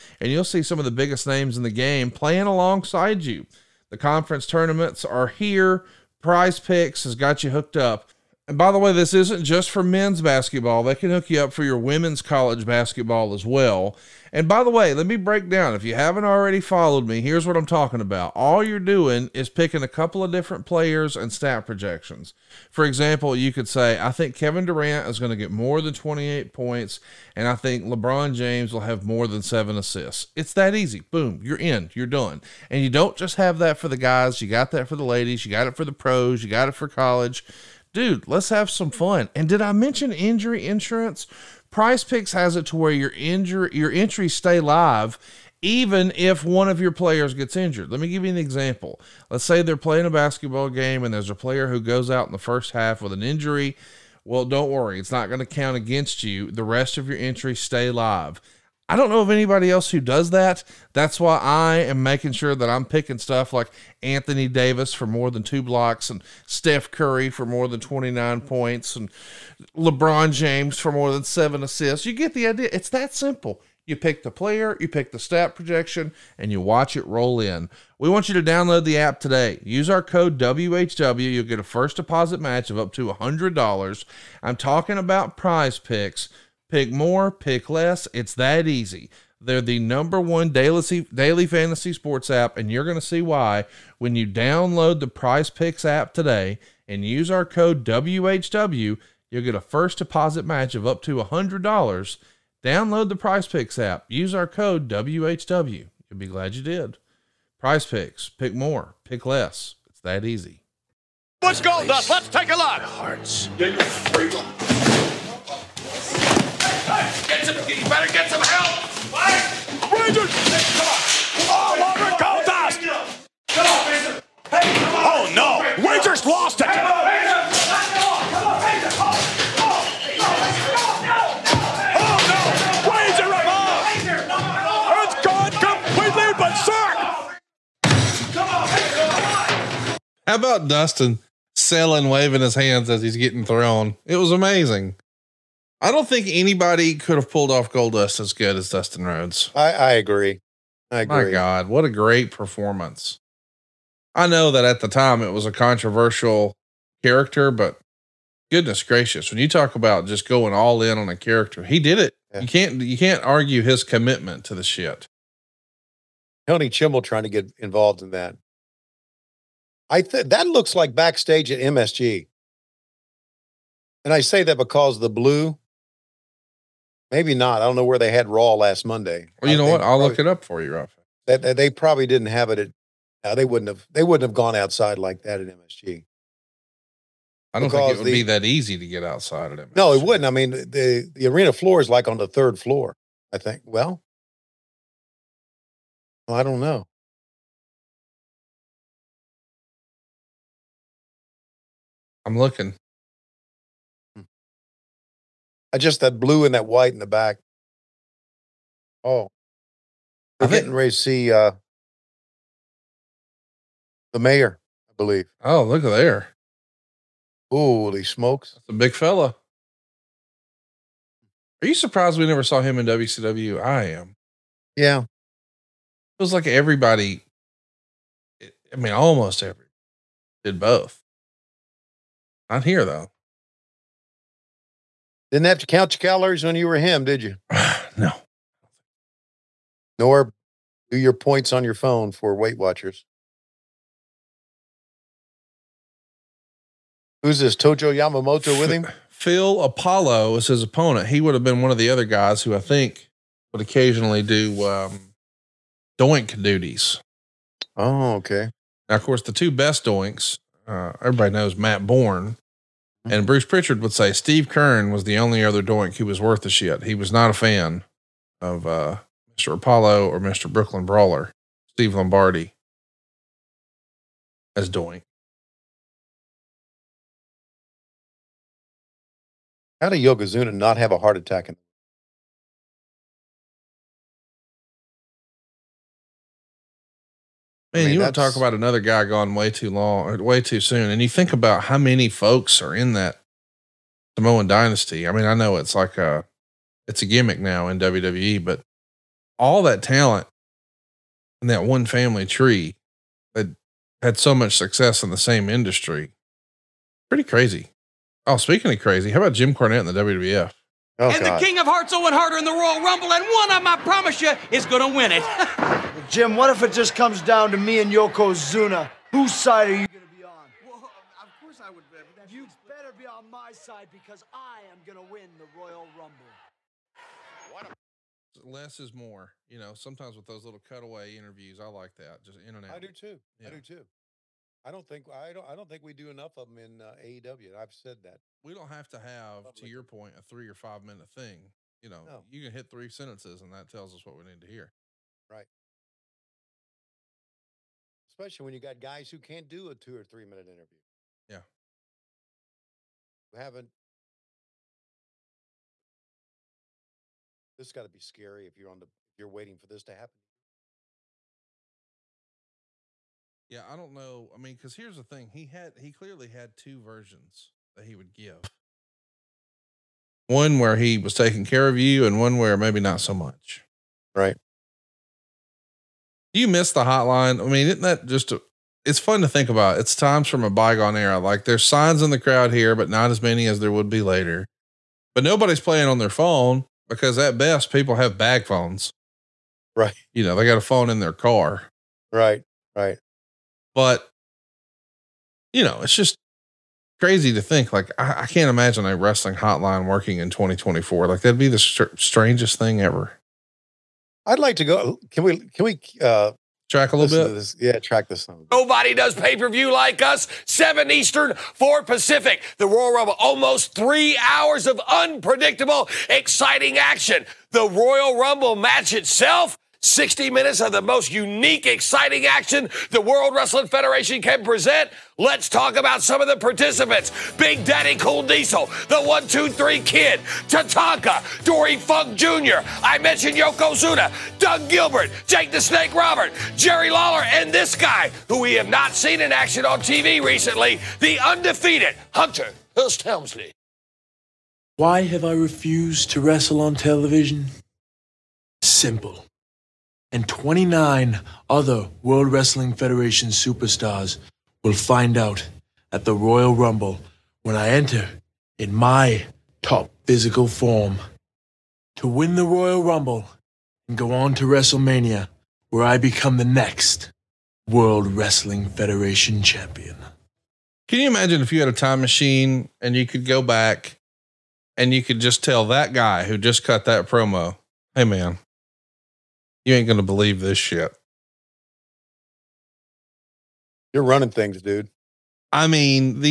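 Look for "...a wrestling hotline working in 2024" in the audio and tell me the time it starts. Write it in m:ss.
6:38.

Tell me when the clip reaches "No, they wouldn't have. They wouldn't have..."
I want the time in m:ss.
3:03.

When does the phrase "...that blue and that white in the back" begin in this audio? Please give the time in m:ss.
3:26.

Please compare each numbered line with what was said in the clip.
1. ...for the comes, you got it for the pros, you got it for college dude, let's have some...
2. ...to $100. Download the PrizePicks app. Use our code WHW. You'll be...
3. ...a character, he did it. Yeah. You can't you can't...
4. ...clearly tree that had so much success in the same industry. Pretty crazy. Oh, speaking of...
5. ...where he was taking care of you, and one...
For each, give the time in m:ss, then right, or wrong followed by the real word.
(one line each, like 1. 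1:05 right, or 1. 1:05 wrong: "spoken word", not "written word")
1. 0:34 wrong: "ladies", not "comes"
2. 1:41 right
3. 2:41 right
4. 5:01 wrong: "family", not "clearly"
5. 6:10 right.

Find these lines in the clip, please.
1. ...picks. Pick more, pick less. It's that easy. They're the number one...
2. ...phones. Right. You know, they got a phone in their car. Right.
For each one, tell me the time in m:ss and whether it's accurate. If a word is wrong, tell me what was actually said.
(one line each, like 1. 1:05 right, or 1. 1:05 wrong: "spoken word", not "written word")
1. 1:25 right
2. 6:28 right.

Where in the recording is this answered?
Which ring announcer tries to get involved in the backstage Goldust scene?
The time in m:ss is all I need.
2:46.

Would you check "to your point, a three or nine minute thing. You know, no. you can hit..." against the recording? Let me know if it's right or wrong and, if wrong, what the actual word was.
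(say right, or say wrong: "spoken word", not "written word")
wrong: "five", not "nine".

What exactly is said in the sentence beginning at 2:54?
And I say that because the blue Maybe not.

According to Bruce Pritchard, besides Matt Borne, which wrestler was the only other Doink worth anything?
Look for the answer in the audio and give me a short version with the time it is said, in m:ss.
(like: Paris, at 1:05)
Steve Keirn, at 4:24.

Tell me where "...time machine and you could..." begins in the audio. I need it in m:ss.
7:51.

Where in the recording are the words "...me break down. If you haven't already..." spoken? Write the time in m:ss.
0:15.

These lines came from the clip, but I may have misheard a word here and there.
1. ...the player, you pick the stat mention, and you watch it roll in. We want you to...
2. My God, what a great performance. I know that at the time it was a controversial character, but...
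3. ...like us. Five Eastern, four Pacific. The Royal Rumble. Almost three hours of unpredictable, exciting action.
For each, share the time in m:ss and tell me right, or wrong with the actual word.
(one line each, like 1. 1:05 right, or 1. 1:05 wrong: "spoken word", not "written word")
1. 1:14 wrong: "projection", not "mention"
2. 2:31 right
3. 6:49 wrong: "Seven", not "Five".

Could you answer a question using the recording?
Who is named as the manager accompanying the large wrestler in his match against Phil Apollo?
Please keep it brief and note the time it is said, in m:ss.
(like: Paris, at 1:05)
Tojo Yamamoto, at 4:07.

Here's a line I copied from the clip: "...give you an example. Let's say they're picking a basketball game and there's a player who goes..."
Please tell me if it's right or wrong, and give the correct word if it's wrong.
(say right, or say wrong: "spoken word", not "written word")
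wrong: "playing", not "picking".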